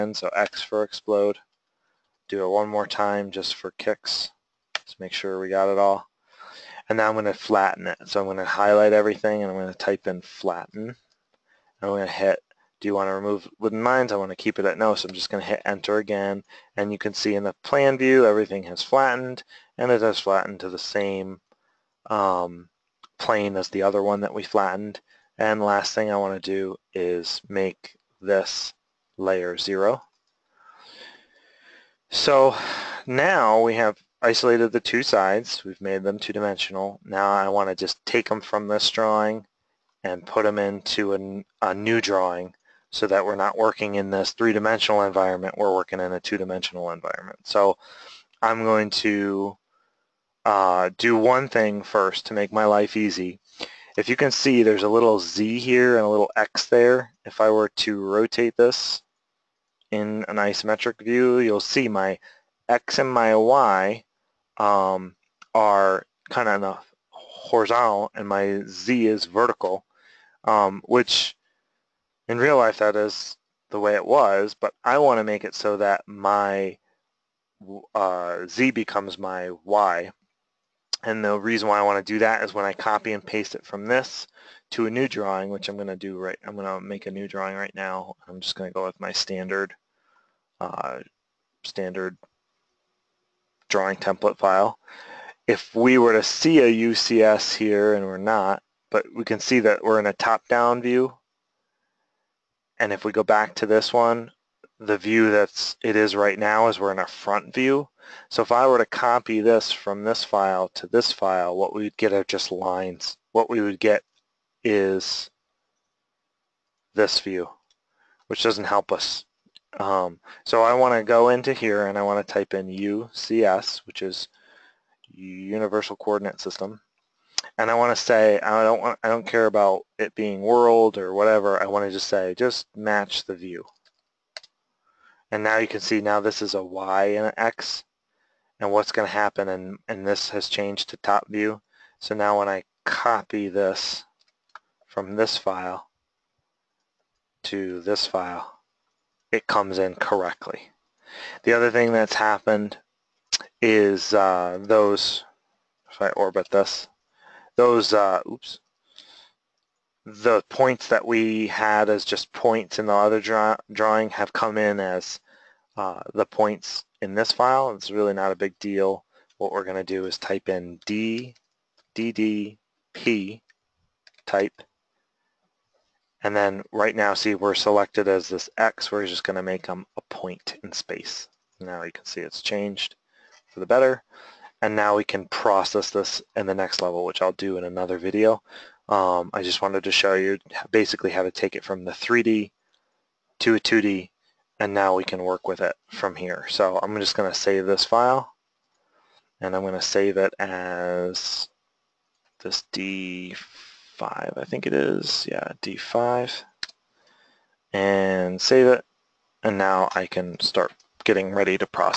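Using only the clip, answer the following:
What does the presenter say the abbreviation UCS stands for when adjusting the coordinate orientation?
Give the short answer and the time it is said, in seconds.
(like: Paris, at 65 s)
Universal Coordinate System, at 125 s.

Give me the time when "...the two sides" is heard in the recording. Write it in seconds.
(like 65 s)
34 s.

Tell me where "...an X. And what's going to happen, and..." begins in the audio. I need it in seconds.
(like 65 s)
137 s.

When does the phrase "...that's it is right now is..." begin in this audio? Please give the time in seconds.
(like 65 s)
105 s.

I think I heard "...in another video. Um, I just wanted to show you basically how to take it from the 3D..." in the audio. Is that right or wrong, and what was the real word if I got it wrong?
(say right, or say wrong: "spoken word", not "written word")
right.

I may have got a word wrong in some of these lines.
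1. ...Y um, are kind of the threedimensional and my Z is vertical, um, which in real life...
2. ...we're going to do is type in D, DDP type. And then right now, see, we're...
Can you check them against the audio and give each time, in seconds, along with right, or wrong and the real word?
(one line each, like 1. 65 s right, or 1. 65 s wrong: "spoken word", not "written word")
1. 63 s wrong: "horizontal", not "threedimensional"
2. 169 s right.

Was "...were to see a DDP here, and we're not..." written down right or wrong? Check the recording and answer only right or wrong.
wrong.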